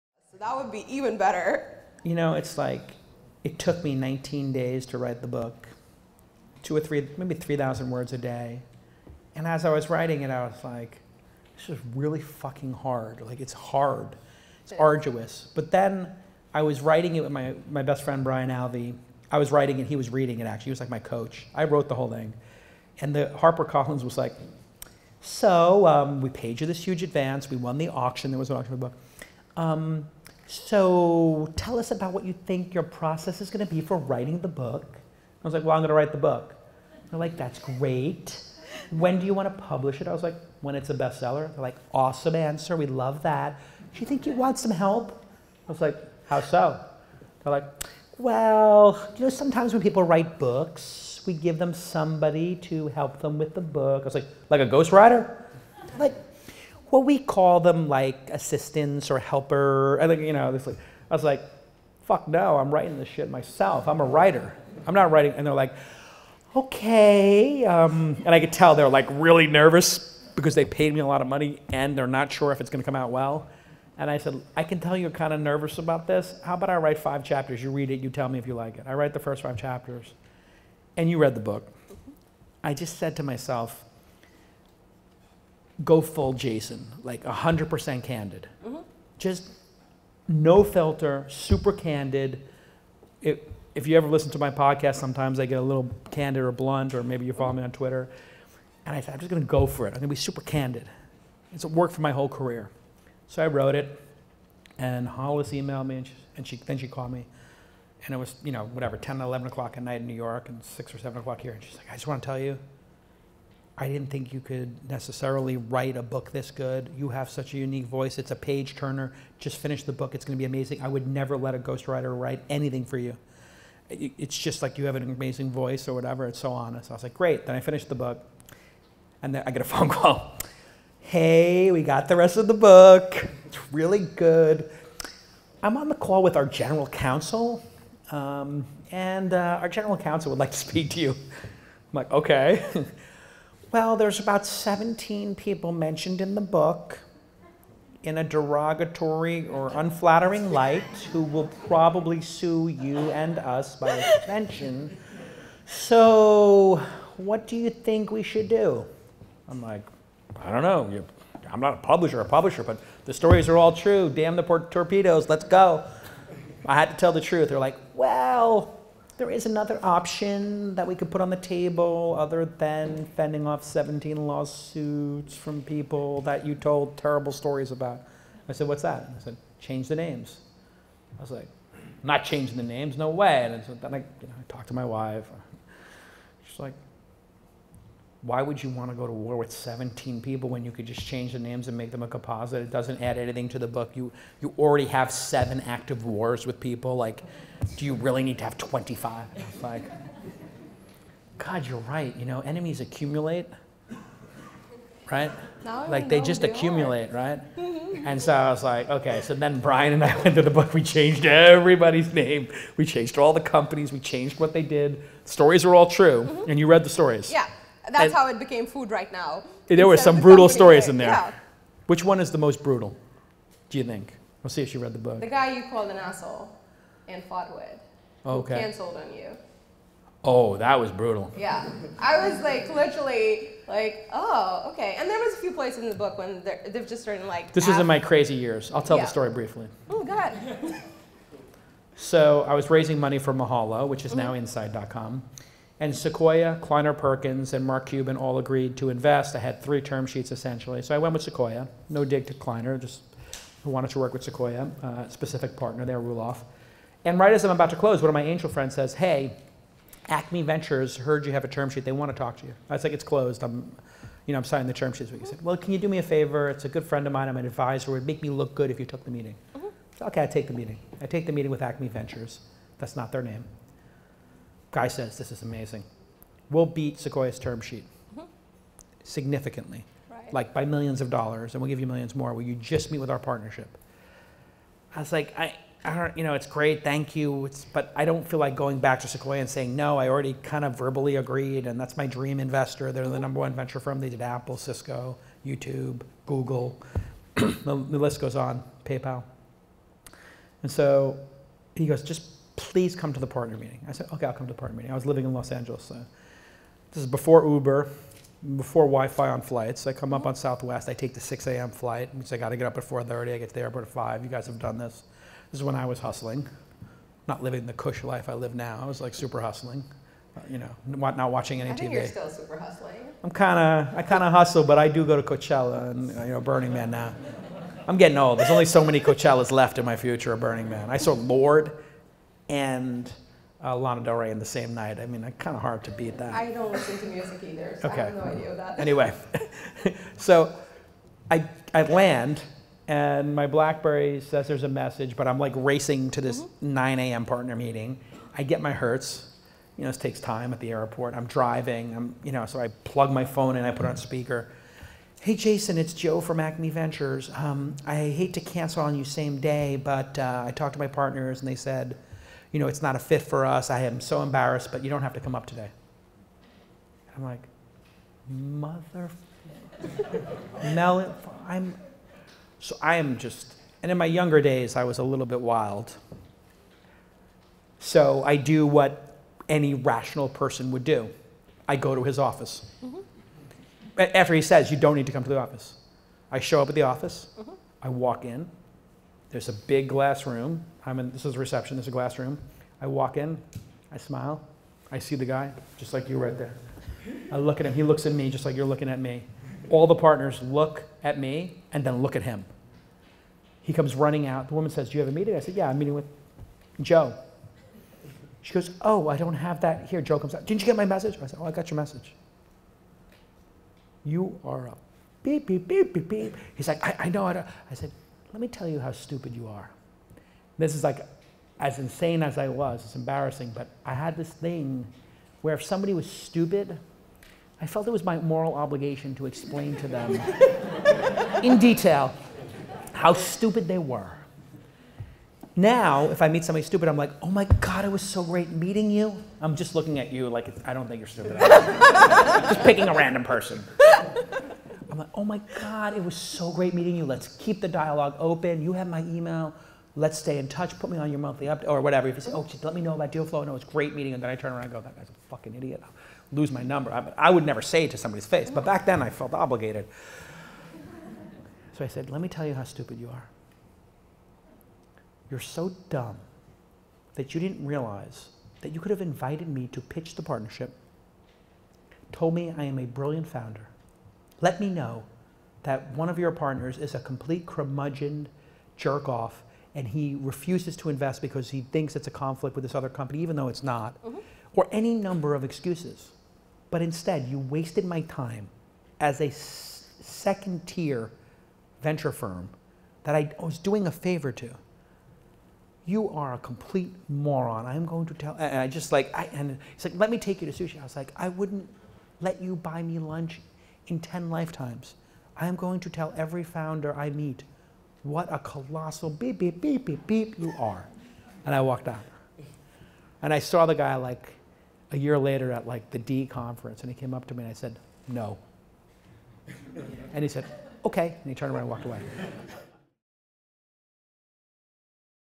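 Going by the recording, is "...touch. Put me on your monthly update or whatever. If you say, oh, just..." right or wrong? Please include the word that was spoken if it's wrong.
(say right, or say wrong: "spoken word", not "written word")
right.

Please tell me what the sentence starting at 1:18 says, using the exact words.
I write the first five chapters.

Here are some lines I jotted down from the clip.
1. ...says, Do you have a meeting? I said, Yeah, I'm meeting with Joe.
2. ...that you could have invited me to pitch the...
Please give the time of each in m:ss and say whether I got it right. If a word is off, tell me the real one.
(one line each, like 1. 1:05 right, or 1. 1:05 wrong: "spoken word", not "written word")
1. 6:44 right
2. 7:48 right.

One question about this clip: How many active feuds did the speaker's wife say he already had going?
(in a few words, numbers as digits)
7.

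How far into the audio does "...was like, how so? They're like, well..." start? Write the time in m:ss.
0:45.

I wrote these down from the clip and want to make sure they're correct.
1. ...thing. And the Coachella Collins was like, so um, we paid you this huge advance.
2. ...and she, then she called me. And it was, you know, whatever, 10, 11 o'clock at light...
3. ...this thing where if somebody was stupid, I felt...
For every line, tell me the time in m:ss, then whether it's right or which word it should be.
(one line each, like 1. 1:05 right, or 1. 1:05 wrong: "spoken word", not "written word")
1. 0:22 wrong: "Harper", not "Coachella"
2. 1:46 wrong: "night", not "light"
3. 7:04 right.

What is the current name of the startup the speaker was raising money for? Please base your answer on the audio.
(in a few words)
inside.com.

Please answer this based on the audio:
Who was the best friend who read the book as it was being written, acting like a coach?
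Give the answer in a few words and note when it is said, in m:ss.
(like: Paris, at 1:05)
Brian Alvey, at 0:18.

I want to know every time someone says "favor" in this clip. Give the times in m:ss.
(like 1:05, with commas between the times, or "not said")
4:26, 8:13.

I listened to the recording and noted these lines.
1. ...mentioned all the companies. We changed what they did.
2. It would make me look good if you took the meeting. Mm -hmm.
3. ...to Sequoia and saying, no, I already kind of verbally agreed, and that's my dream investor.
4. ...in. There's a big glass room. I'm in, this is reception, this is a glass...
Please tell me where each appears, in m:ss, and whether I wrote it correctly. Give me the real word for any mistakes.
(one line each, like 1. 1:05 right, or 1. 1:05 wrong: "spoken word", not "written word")
1. 3:32 wrong: "changed", not "mentioned"
2. 4:27 right
3. 4:49 right
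4. 6:28 right.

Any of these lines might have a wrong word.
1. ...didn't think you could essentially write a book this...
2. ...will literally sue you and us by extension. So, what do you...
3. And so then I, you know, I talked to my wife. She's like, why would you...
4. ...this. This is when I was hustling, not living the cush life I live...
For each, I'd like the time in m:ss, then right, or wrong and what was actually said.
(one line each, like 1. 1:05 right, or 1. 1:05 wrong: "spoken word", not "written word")
1. 1:53 wrong: "necessarily", not "essentially"
2. 2:31 wrong: "probably", not "literally"
3. 3:03 right
4. 5:14 right.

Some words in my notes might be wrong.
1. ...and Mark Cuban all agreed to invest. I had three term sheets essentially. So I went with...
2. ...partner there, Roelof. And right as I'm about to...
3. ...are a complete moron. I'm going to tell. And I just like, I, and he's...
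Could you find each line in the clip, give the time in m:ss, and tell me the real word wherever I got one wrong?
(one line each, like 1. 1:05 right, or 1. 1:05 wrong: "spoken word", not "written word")
1. 4:07 right
2. 4:15 right
3. 8:16 right.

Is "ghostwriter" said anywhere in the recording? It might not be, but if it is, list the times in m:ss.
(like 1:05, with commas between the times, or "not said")
0:54, 2:01.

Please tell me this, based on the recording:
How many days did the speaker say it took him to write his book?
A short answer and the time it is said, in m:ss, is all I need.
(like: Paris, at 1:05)
19, at 0:03.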